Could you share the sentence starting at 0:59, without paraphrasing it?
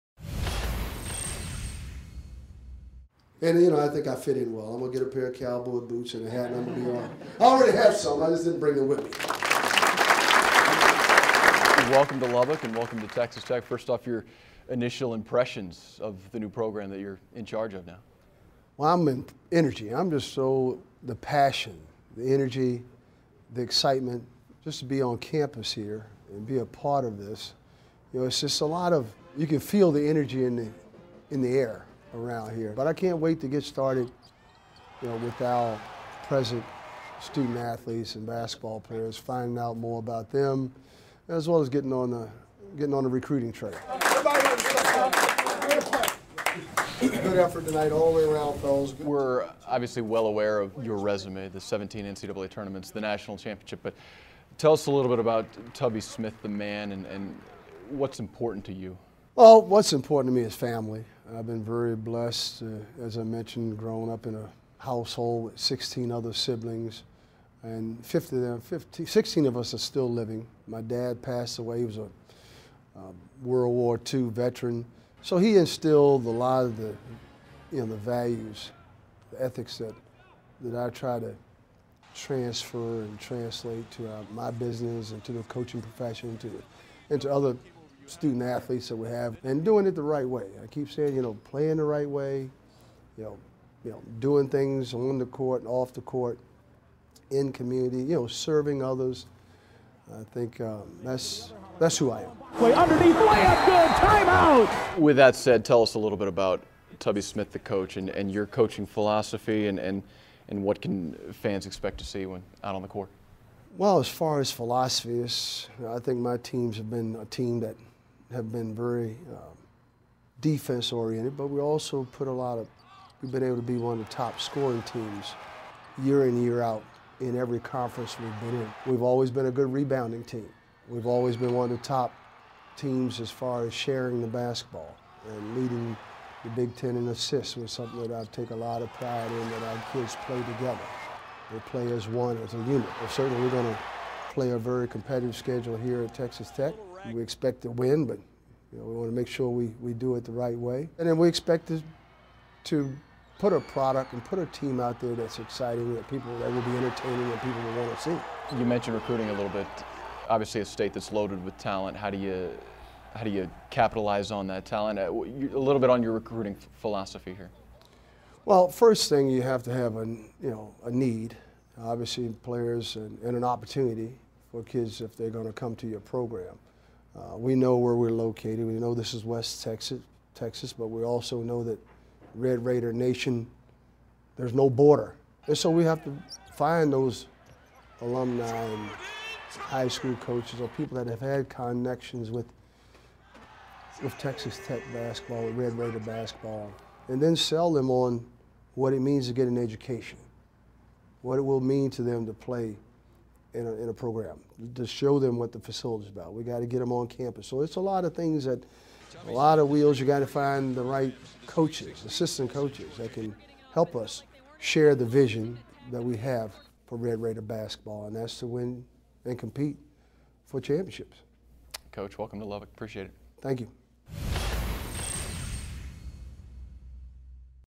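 Well, what's important to me is family.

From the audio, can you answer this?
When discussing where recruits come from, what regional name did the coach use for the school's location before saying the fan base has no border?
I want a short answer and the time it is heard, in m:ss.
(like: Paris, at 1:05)
West Texas, at 2:59.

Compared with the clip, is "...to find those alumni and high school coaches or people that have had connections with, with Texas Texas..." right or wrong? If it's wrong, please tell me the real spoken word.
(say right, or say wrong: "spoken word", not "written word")
wrong: "Tech", not "Texas".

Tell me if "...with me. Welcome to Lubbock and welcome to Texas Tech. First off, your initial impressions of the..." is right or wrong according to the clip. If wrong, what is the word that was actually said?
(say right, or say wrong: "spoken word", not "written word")
right.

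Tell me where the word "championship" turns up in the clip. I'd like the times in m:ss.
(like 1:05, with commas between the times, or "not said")
0:53, 3:40.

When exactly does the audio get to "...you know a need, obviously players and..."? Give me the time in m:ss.
2:50.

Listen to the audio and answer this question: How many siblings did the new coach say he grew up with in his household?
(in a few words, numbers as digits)
16.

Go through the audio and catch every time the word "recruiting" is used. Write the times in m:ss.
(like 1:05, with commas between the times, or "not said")
0:43, 2:38, 2:46.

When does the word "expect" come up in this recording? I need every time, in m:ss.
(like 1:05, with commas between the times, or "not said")
1:51, 2:27, 2:31.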